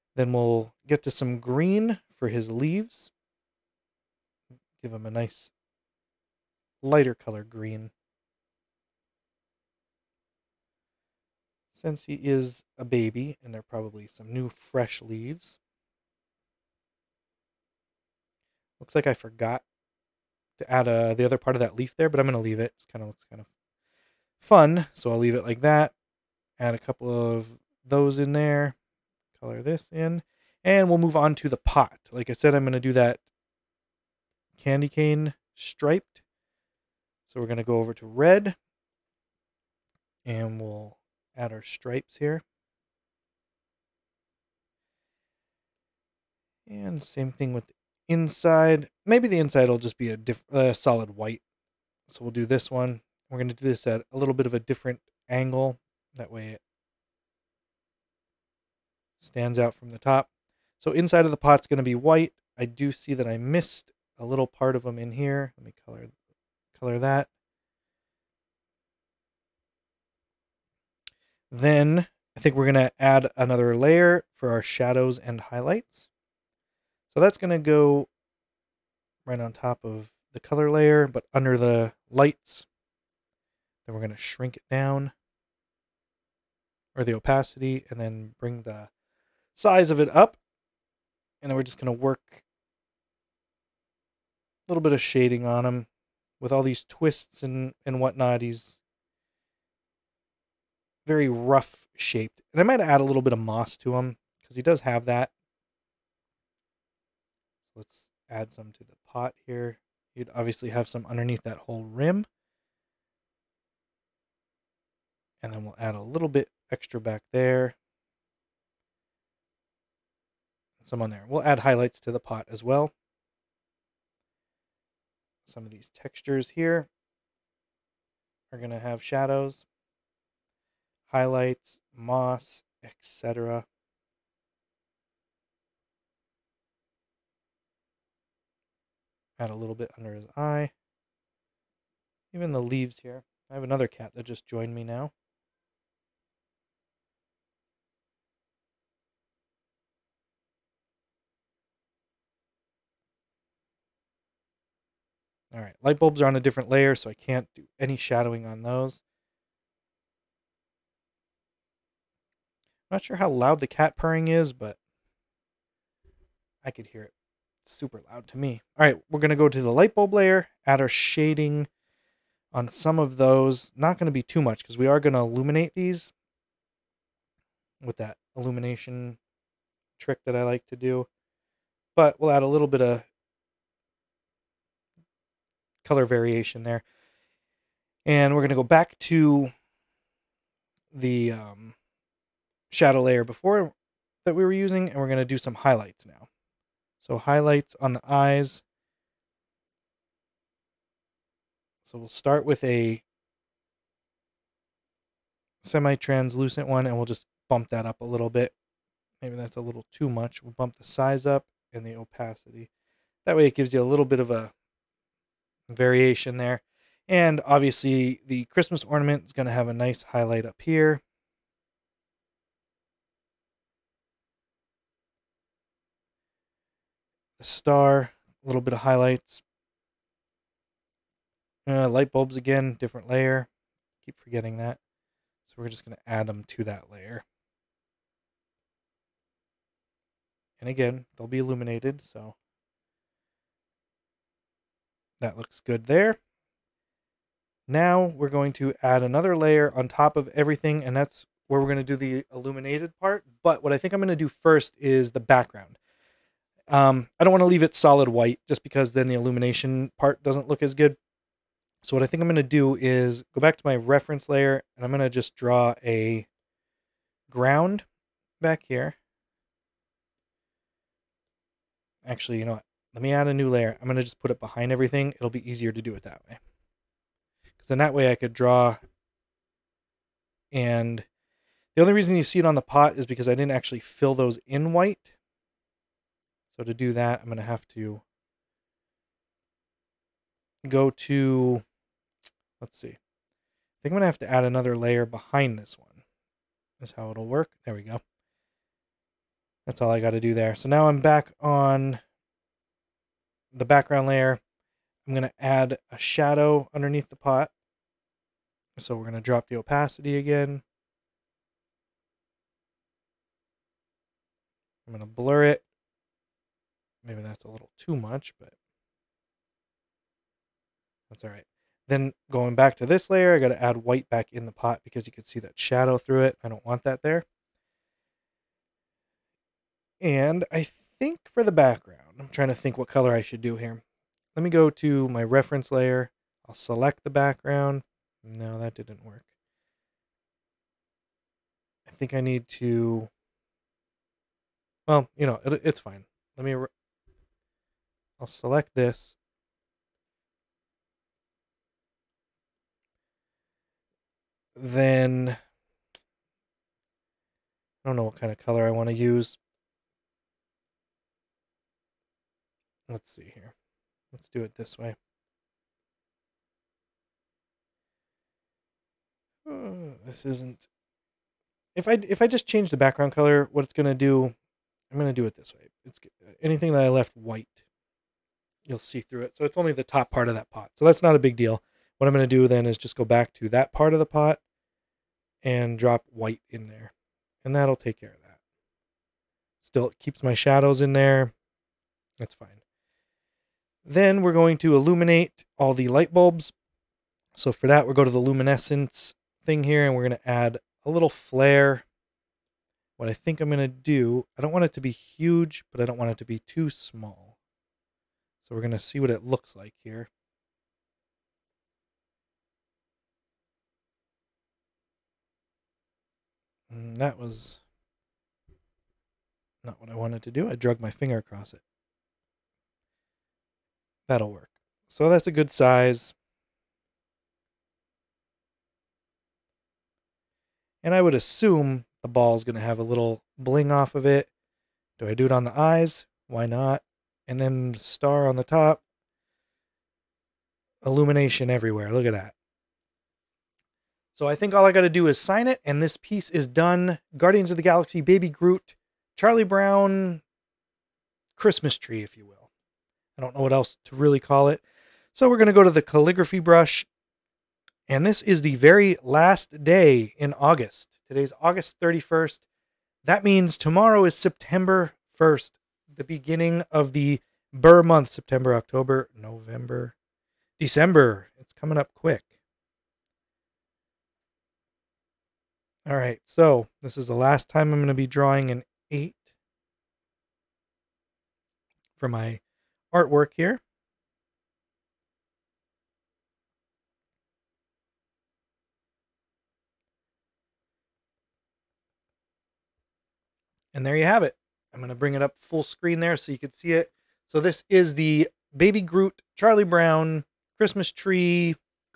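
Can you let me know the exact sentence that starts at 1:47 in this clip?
Let's add some to the pot here.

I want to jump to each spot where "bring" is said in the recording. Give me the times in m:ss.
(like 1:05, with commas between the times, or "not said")
1:28, 8:14.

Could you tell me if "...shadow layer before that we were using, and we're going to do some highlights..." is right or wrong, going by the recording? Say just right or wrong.
right.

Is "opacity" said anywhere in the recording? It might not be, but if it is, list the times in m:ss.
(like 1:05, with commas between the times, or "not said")
1:27, 3:31, 5:09.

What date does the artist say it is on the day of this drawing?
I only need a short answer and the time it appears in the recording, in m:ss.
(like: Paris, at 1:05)
August 31st, at 7:41.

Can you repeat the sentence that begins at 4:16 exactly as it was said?
Um, I don't want to leave it solid white just because then the illumination part doesn't look as good.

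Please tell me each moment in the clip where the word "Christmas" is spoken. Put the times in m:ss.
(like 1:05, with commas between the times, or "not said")
3:38, 7:31, 8:20.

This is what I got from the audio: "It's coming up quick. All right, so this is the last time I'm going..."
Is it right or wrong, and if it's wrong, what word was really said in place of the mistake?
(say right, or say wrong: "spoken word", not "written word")
right.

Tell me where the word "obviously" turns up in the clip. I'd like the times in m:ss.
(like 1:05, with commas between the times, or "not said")
1:50, 3:37.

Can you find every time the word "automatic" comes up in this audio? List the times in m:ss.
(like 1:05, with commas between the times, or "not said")
not said.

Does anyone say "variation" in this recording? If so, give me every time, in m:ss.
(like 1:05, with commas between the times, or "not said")
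3:06, 3:35.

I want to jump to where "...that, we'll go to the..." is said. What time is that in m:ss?
6:37.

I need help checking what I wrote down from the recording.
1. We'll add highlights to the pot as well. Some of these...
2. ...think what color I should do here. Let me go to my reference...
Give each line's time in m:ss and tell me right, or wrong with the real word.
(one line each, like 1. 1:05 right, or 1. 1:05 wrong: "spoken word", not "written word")
1. 2:01 right
2. 5:32 right.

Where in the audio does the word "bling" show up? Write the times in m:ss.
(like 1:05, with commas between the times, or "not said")
7:13.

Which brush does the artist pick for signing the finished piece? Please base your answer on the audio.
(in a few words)
Calligraphy brush.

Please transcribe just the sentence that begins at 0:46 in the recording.
And same thing with the inside.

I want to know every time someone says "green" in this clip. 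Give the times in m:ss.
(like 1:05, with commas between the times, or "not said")
0:01, 0:07.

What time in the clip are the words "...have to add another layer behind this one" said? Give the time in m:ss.
4:54.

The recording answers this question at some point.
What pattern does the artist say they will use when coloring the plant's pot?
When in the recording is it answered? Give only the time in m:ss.
0:34.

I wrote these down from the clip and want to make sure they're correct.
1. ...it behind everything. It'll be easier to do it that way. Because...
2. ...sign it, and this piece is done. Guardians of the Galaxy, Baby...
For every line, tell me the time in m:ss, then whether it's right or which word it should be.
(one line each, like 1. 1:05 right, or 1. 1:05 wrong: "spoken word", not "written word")
1. 4:34 right
2. 7:25 right.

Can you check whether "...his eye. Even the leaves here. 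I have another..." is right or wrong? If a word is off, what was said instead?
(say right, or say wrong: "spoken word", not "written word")
right.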